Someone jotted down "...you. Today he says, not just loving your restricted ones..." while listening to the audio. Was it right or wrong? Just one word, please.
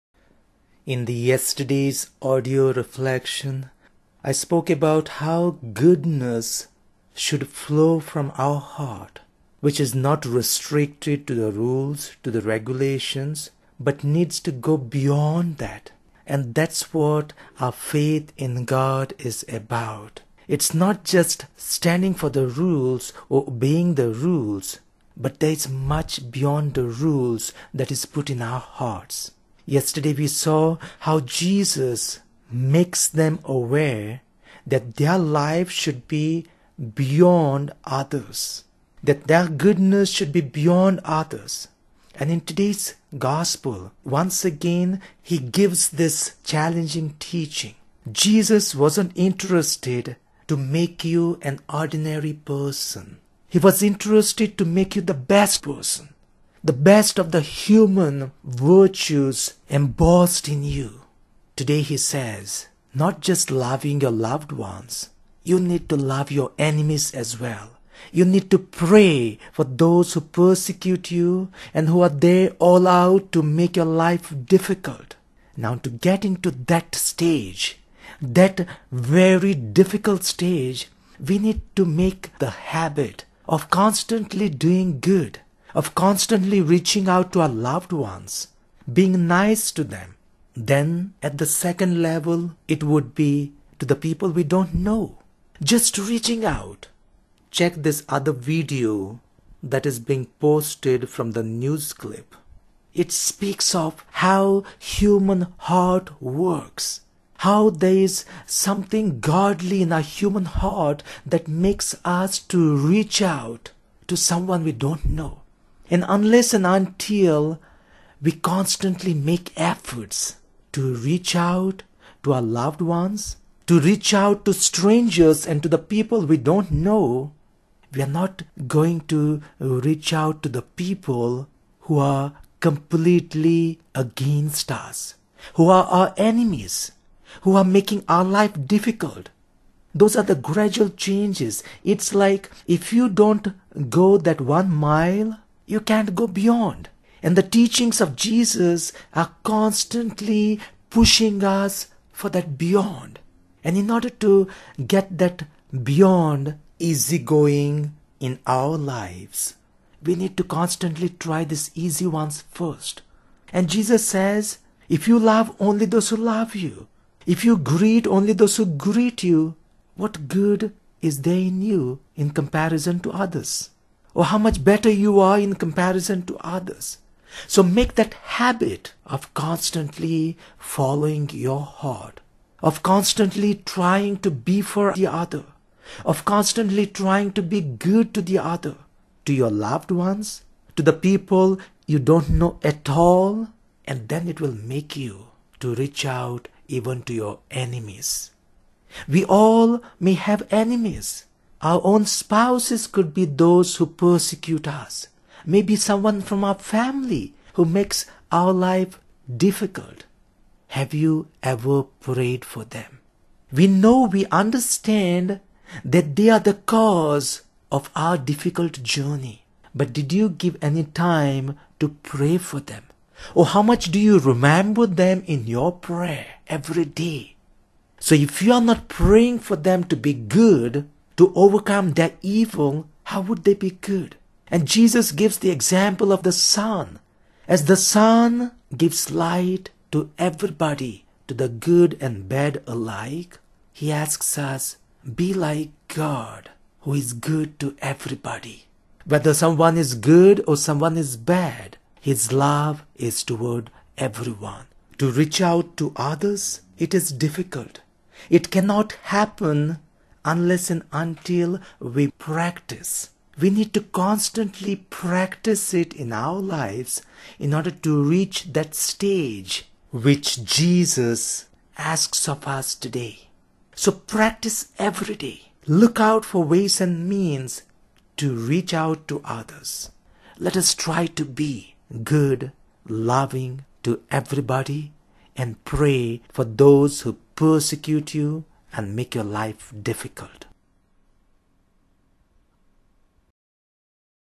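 wrong.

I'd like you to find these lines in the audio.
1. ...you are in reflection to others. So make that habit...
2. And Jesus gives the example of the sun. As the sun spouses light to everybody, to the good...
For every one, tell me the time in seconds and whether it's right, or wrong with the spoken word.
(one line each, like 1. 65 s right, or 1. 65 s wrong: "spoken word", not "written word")
1. 174 s wrong: "comparison", not "reflection"
2. 234 s wrong: "gives", not "spouses".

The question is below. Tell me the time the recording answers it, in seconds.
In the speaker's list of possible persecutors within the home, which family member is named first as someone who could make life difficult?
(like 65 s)
202 s.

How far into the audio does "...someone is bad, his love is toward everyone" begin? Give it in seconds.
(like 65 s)
250 s.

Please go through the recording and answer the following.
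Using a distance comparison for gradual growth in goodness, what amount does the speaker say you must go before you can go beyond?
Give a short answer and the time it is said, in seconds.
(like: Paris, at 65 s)
One mile, at 144 s.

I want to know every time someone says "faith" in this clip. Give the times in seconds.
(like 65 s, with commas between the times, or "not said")
17 s.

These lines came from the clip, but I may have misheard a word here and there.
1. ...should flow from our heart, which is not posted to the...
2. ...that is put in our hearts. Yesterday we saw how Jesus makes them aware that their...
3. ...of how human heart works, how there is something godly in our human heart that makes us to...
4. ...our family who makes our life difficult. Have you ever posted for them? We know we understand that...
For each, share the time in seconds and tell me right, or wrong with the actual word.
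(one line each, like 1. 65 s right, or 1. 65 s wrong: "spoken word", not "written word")
1. 7 s wrong: "restricted", not "posted"
2. 27 s right
3. 103 s right
4. 206 s wrong: "prayed", not "posted".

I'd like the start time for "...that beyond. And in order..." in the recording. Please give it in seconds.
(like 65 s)
152 s.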